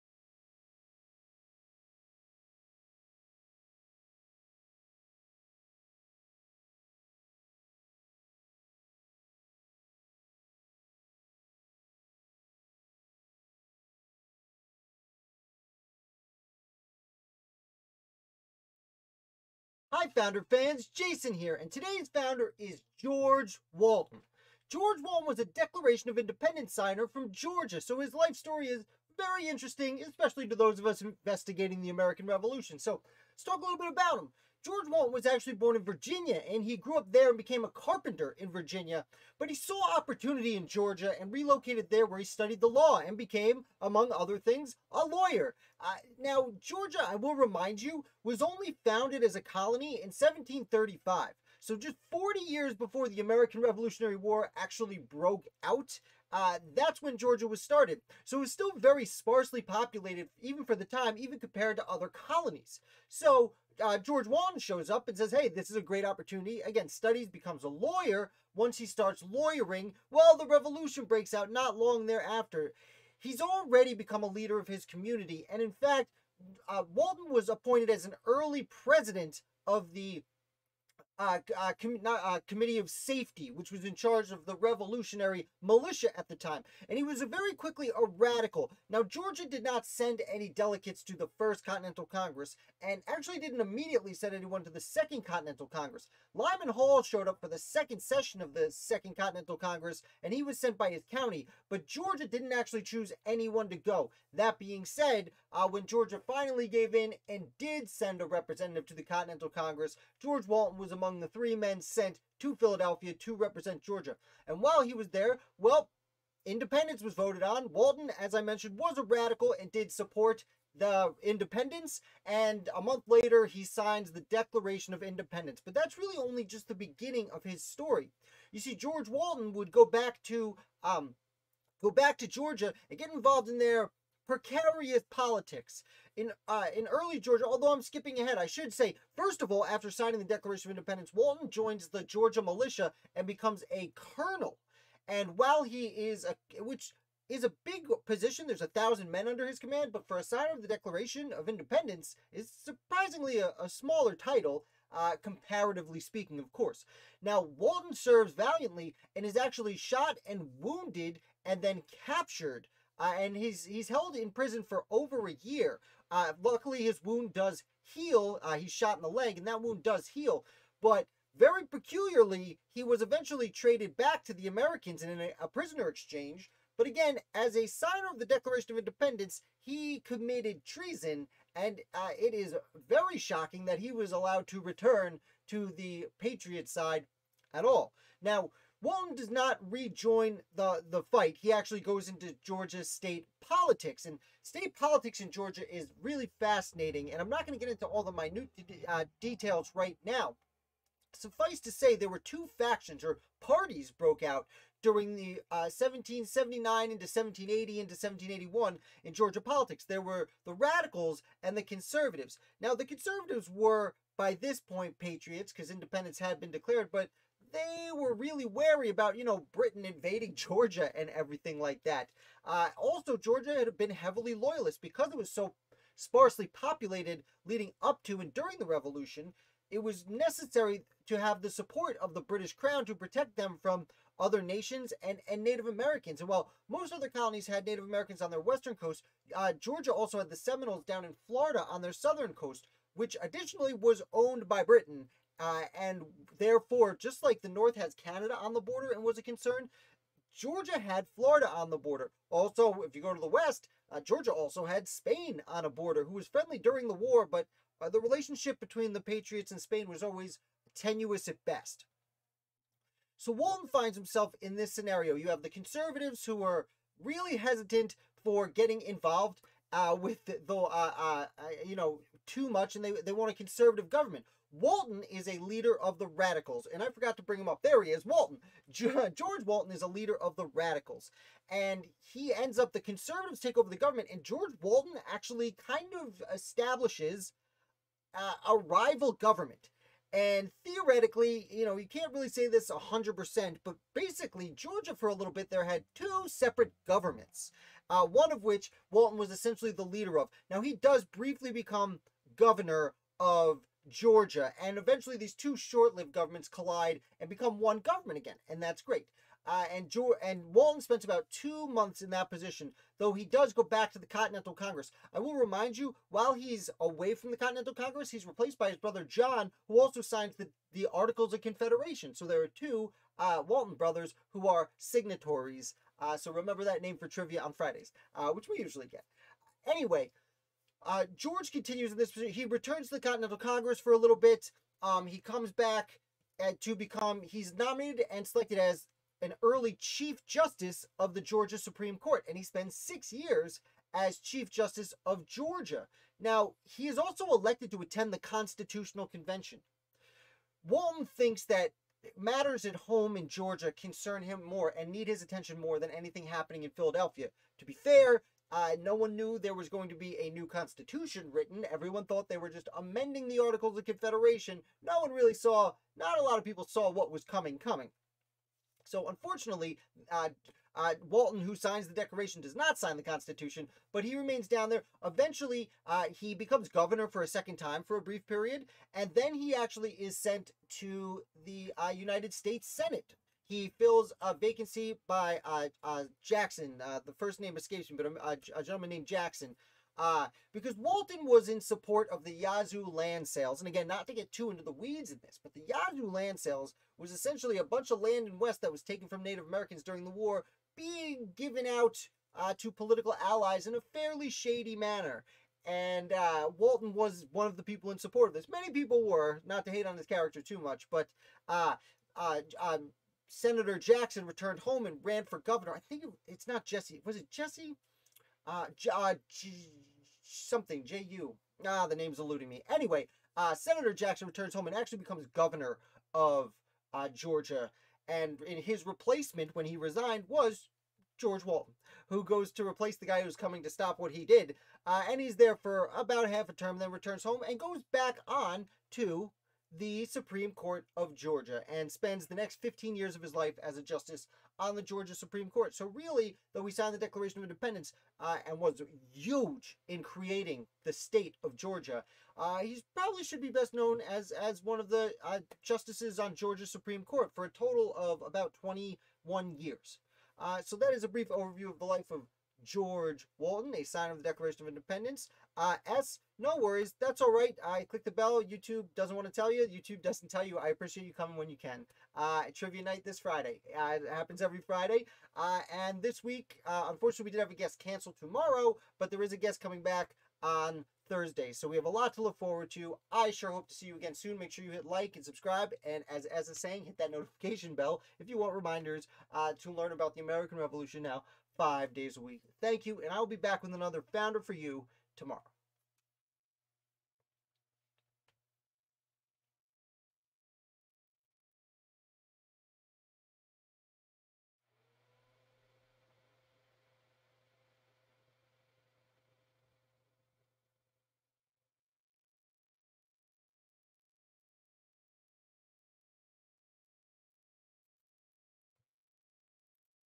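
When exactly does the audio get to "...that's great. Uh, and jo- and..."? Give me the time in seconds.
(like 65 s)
308 s.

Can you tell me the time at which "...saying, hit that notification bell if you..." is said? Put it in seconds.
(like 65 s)
486 s.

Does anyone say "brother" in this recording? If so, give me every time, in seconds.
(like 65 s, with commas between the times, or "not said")
318 s, 323 s.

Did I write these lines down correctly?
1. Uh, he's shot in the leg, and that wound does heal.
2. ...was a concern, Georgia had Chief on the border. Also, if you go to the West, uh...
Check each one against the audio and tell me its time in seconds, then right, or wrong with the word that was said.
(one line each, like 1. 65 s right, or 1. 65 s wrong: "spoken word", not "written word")
1. 168 s right
2. 249 s wrong: "Florida", not "Chief".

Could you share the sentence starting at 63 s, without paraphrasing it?
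So uh, George Walton shows up and says, hey, this is a great opportunity.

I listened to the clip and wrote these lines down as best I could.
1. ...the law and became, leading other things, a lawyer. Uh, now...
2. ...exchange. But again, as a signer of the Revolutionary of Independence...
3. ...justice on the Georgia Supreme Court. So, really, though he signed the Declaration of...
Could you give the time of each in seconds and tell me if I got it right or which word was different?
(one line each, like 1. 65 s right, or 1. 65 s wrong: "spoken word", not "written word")
1. 42 s wrong: "among", not "leading"
2. 175 s wrong: "Declaration", not "Revolutionary"
3. 443 s right.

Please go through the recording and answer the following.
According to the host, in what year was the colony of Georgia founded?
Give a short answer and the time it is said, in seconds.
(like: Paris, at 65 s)
1735, at 50 s.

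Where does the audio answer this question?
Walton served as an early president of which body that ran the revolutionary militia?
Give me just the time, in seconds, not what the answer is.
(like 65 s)
82 s.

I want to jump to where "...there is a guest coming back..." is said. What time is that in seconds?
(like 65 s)
479 s.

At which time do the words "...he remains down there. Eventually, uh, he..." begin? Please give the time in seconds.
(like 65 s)
374 s.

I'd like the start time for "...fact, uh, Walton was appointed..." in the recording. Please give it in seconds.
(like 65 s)
75 s.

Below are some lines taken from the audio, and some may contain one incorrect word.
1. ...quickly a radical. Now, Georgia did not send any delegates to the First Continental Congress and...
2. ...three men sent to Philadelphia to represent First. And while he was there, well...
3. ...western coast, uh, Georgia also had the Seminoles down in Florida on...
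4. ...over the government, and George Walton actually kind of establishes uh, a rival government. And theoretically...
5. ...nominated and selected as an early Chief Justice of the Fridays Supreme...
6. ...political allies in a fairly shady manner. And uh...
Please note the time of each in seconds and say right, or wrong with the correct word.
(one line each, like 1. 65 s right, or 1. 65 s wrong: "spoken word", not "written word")
1. 87 s right
2. 111 s wrong: "Georgia", not "First"
3. 238 s right
4. 283 s right
5. 337 s wrong: "Georgia", not "Fridays"
6. 402 s right.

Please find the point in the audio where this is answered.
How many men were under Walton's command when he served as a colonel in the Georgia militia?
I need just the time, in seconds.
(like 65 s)
148 s.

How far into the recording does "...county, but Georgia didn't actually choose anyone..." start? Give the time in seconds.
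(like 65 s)
101 s.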